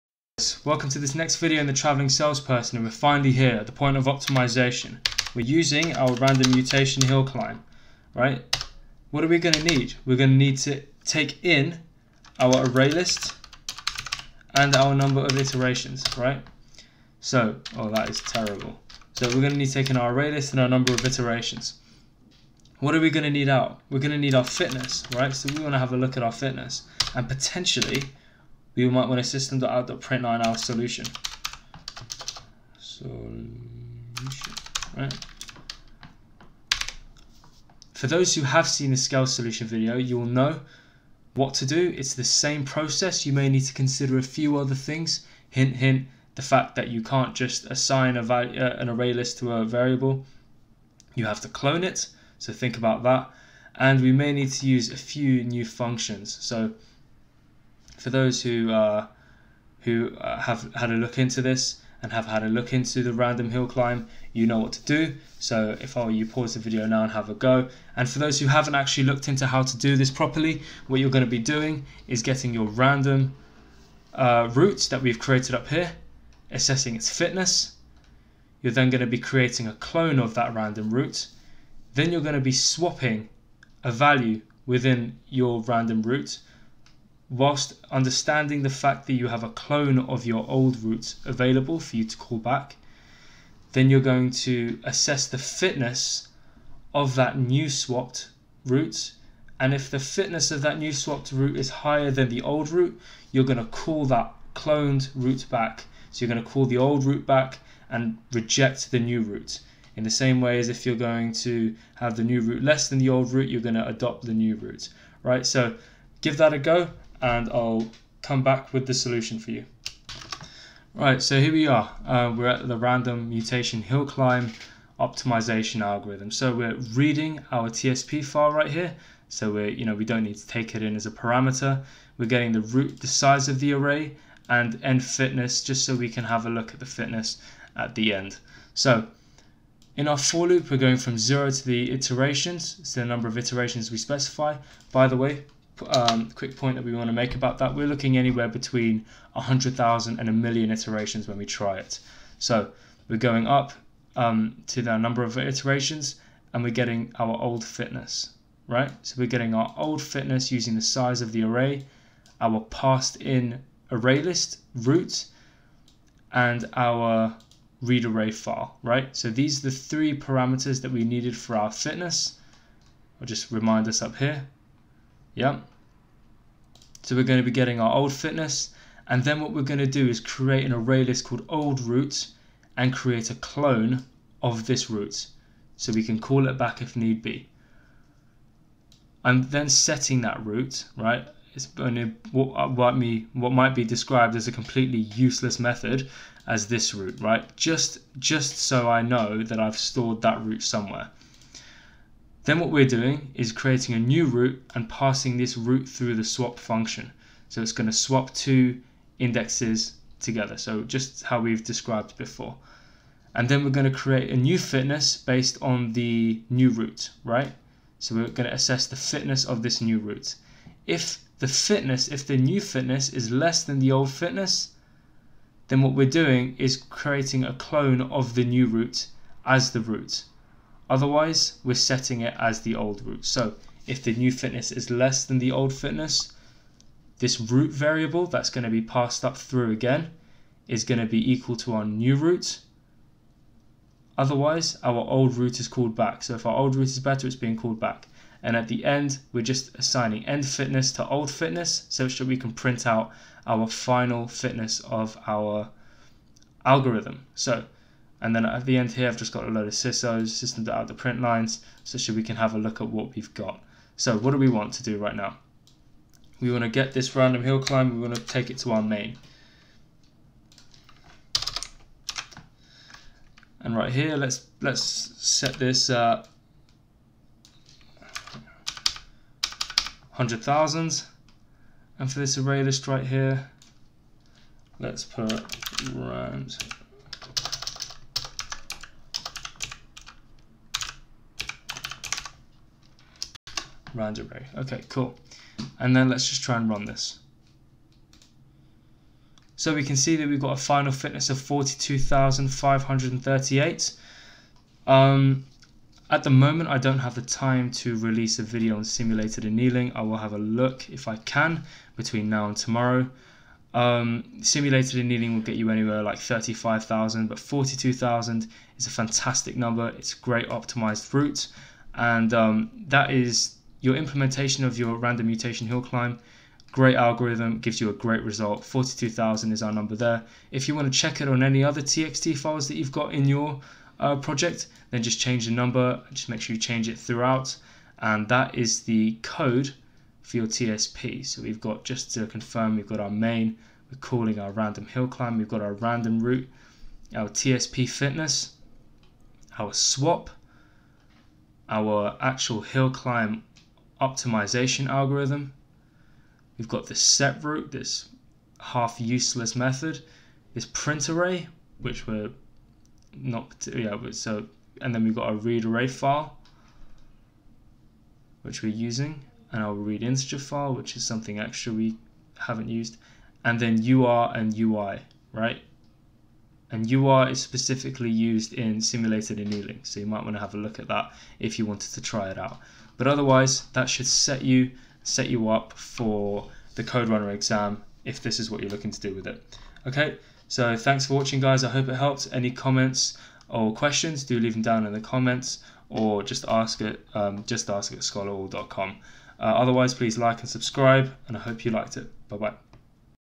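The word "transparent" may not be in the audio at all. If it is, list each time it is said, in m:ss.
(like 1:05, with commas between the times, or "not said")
not said.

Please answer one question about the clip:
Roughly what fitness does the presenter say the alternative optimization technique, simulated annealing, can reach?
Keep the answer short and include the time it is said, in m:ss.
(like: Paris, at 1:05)
35,000, at 5:16.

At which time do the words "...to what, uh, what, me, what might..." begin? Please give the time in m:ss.
3:11.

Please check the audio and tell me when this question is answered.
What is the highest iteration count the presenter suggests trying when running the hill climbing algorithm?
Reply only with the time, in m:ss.
2:30.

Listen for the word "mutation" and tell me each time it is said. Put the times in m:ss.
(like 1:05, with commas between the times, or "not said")
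0:06, 2:03, 5:25.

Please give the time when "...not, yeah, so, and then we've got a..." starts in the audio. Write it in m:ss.
6:03.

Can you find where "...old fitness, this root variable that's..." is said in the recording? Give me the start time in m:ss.
3:55.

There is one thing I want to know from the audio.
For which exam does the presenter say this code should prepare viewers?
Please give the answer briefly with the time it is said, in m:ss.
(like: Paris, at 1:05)
CodeRunner exam, at 6:26.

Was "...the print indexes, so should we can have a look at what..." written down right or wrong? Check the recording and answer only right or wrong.
wrong.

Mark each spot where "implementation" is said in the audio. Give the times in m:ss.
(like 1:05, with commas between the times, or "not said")
5:23.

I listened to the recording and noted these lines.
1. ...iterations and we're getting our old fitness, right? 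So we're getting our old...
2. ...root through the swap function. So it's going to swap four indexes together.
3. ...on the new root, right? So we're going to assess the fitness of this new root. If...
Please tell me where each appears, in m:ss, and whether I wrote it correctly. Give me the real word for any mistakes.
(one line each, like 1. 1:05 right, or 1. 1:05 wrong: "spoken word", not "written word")
1. 2:35 right
2. 3:25 wrong: "two", not "four"
3. 3:35 right.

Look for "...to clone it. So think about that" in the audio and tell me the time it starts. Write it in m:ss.
0:51.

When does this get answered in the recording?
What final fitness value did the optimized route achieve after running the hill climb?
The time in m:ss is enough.
5:01.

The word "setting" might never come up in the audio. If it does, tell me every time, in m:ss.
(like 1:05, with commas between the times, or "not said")
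3:09, 3:51.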